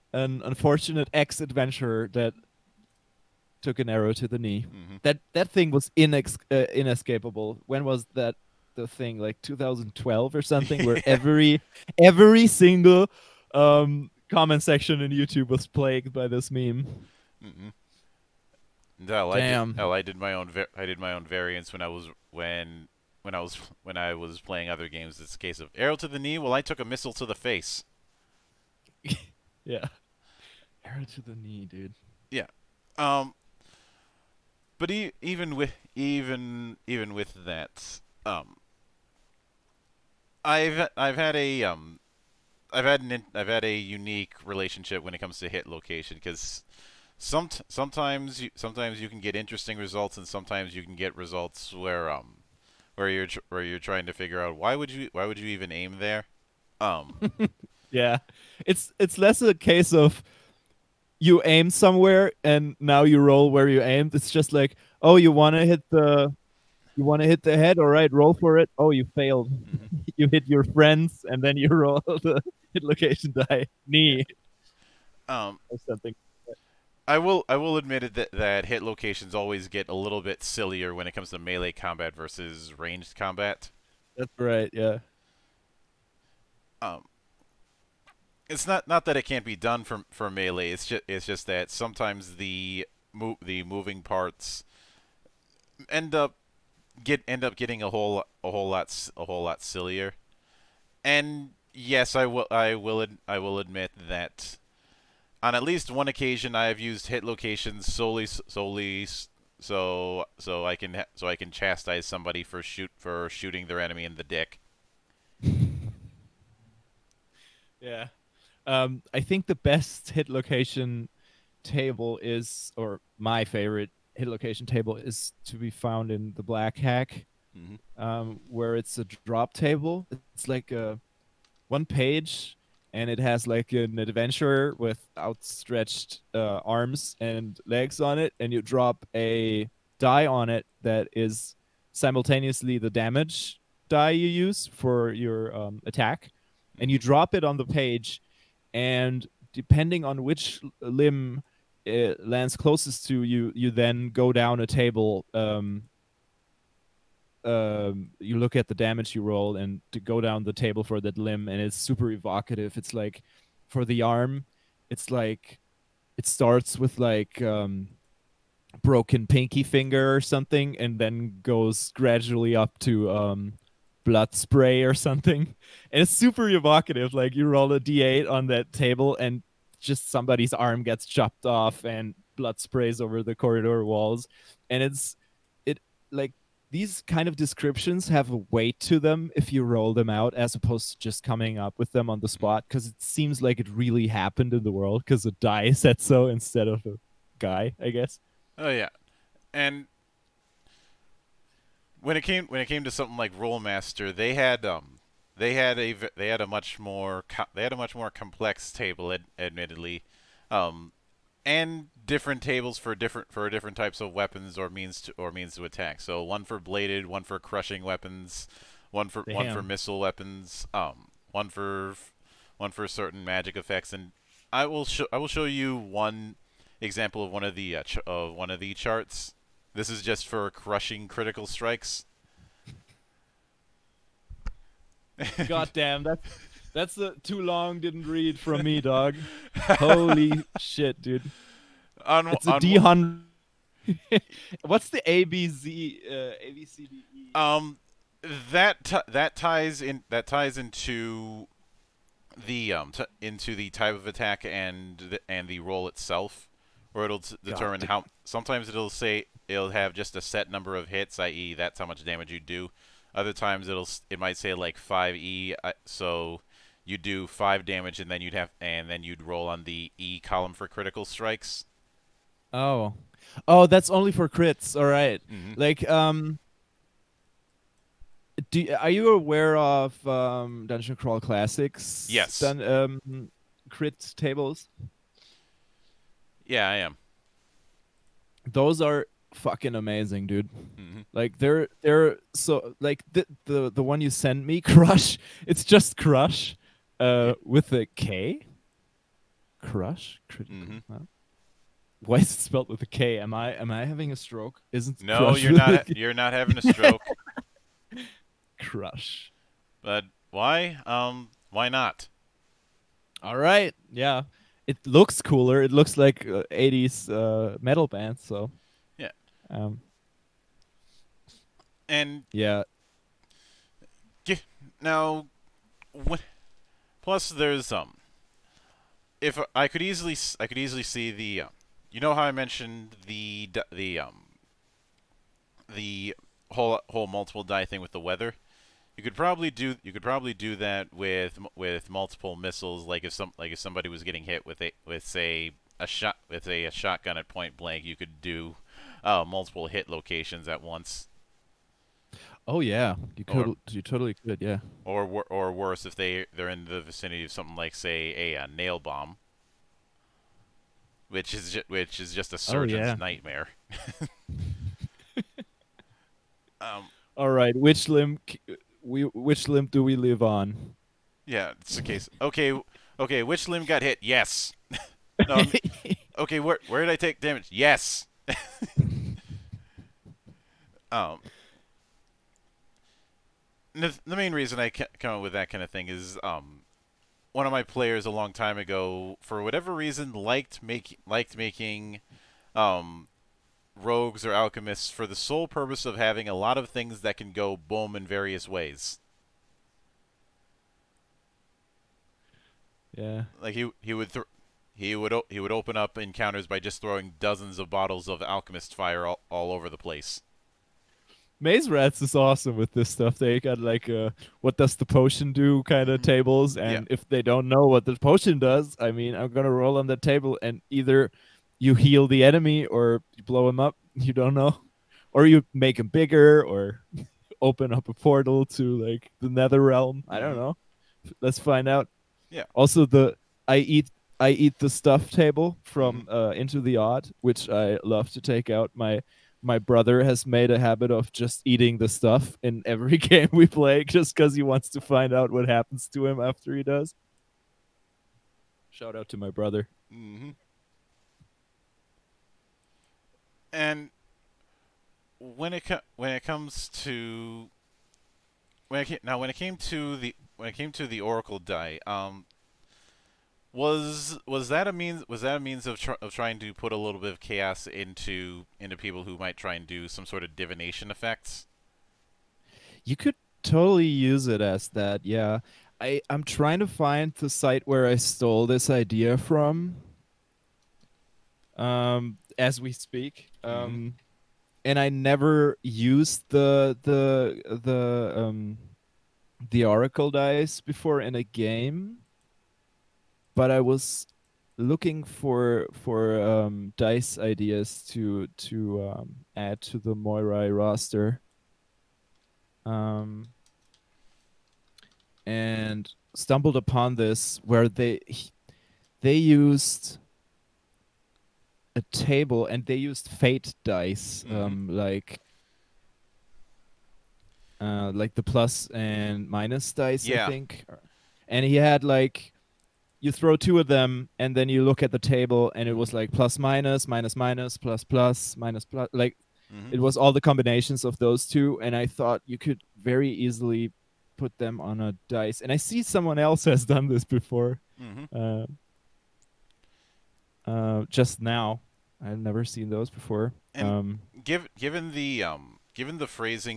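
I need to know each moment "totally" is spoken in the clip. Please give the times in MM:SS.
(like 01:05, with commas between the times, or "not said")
05:53, 07:53.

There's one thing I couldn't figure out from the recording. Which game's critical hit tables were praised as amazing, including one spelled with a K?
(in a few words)
Dungeon Crawl Classics.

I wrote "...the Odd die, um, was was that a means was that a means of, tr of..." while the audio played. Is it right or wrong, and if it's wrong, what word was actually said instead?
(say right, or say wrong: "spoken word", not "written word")
wrong: "Oracle", not "Odd".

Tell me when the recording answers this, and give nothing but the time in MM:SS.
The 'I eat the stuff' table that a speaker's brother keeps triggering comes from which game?
07:16.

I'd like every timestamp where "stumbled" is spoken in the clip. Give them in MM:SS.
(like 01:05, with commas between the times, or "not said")
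08:26.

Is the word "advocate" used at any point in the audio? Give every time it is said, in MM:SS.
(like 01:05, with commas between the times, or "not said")
not said.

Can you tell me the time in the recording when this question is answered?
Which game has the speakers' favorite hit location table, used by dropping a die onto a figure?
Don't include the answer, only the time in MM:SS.
02:06.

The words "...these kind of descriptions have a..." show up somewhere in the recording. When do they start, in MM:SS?
03:06.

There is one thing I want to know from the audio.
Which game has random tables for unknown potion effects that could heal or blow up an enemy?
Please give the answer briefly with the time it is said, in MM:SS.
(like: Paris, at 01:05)
Maze Rats, at 06:51.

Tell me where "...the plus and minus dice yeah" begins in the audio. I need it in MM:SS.
08:38.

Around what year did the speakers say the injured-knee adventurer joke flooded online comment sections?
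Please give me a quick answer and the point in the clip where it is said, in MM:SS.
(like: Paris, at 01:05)
2012, at 00:09.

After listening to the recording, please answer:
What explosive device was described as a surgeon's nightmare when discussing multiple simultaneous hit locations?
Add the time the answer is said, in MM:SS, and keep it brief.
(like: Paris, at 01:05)
nail bomb, at 05:58.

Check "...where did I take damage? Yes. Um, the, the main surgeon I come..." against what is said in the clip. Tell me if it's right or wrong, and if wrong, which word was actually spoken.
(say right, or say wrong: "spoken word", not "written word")
wrong: "reason", not "surgeon".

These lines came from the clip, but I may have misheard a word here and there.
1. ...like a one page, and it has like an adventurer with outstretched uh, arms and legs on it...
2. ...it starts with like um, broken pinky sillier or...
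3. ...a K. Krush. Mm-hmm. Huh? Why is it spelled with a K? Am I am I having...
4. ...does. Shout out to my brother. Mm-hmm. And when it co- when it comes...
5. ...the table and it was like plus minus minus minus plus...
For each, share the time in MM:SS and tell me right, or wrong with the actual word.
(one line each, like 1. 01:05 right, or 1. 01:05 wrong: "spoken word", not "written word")
1. 02:10 right
2. 02:46 wrong: "finger", not "sillier"
3. 04:57 right
4. 07:26 right
5. 08:44 right.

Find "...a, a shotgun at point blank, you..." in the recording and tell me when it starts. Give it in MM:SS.
05:46.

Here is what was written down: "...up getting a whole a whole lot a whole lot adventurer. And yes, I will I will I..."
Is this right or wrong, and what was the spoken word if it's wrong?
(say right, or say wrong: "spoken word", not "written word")
wrong: "sillier", not "adventurer".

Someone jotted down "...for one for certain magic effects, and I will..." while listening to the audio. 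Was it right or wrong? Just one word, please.
right.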